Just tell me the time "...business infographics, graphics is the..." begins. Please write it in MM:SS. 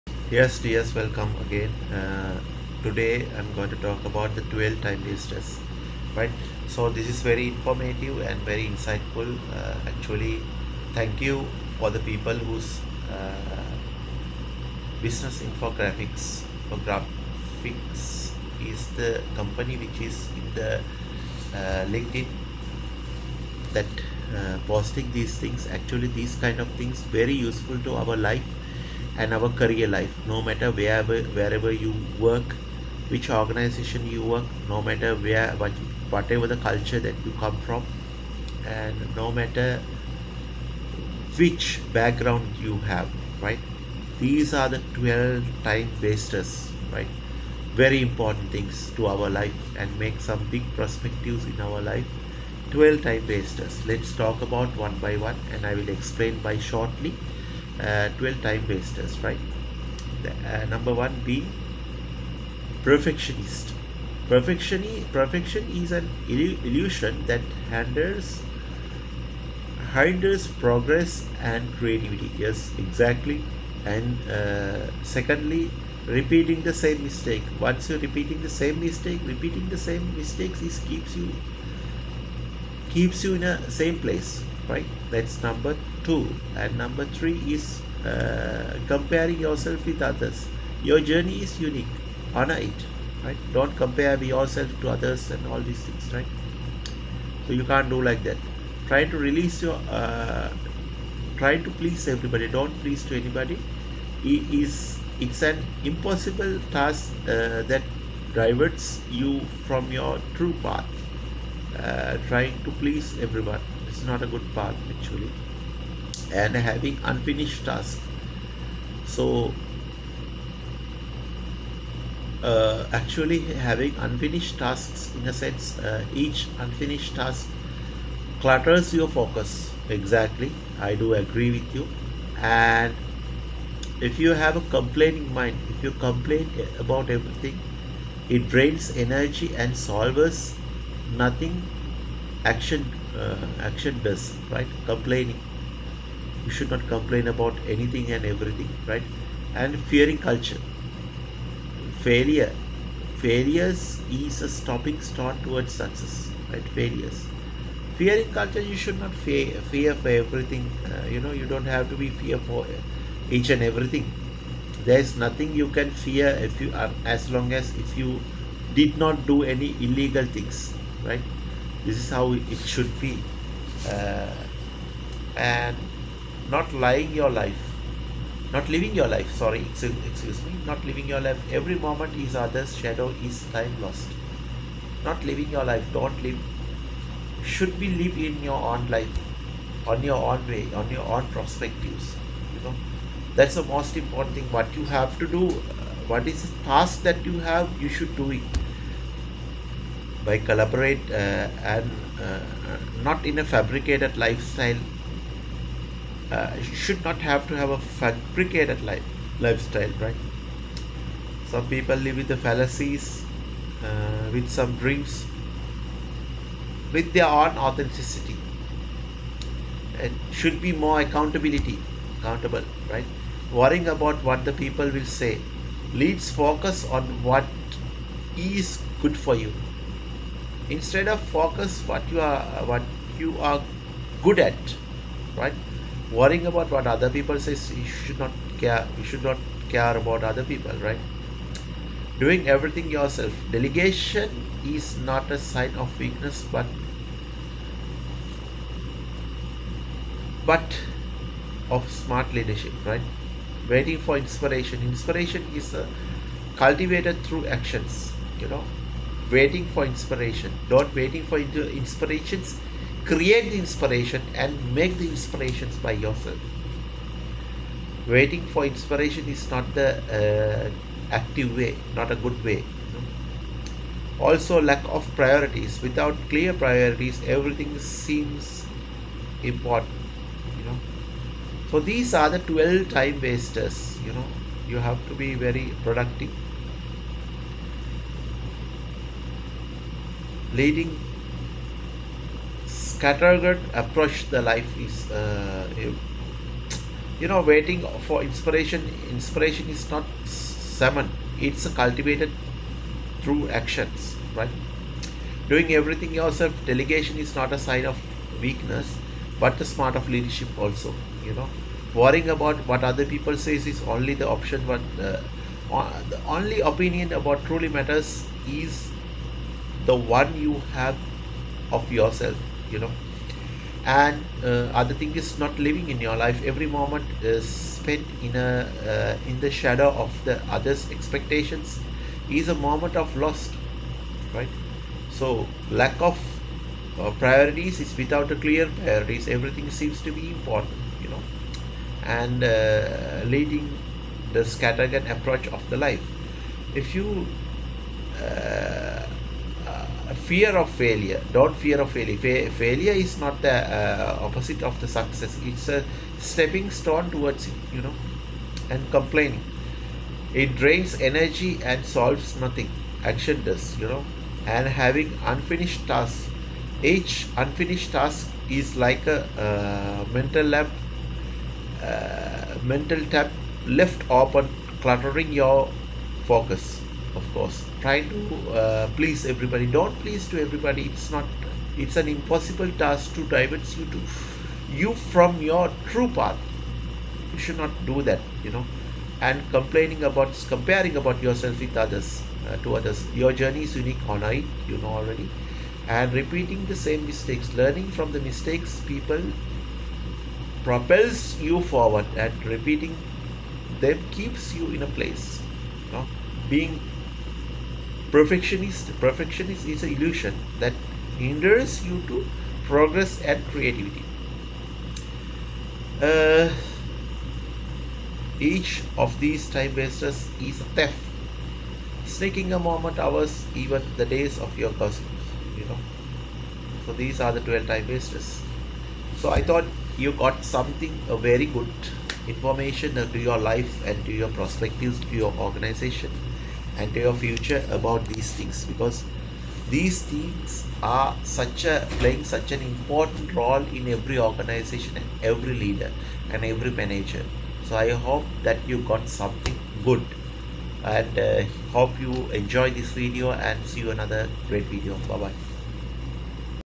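00:15.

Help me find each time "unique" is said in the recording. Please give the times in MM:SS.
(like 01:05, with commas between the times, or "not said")
01:31, 06:33.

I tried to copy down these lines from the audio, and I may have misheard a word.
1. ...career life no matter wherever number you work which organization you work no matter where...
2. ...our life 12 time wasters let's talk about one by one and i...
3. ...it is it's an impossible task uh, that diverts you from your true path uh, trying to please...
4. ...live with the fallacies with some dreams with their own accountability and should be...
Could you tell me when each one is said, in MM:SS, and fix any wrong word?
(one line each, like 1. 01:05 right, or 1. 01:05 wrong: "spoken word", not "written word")
1. 00:29 wrong: "wherever", not "number"
2. 00:51 right
3. 01:44 right
4. 03:31 wrong: "authenticity", not "accountability".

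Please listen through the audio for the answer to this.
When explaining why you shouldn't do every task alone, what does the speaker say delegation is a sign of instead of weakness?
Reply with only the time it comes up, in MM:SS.
04:11.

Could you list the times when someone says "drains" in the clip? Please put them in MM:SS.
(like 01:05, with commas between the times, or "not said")
02:18, 06:00.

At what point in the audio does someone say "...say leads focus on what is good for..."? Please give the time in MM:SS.
03:45.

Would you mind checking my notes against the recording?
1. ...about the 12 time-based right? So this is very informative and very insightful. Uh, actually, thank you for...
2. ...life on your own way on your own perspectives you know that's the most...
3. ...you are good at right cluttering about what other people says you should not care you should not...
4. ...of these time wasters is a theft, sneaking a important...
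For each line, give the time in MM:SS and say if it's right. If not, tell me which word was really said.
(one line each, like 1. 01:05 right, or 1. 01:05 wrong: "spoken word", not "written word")
1. 00:04 right
2. 03:08 right
3. 03:53 wrong: "worrying", not "cluttering"
4. 06:58 wrong: "moment", not "important".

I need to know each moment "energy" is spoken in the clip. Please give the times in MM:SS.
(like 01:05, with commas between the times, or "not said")
02:18, 06:01.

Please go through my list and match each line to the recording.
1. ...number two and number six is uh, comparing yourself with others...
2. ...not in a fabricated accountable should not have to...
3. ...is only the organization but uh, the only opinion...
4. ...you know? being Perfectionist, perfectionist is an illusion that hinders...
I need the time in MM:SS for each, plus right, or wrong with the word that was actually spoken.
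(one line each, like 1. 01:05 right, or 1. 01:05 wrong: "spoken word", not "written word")
1. 01:25 wrong: "three", not "six"
2. 03:23 wrong: "lifestyle", not "accountable"
3. 05:13 wrong: "option", not "organization"
4. 06:45 right.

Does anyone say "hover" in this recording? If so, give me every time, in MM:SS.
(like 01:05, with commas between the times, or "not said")
not said.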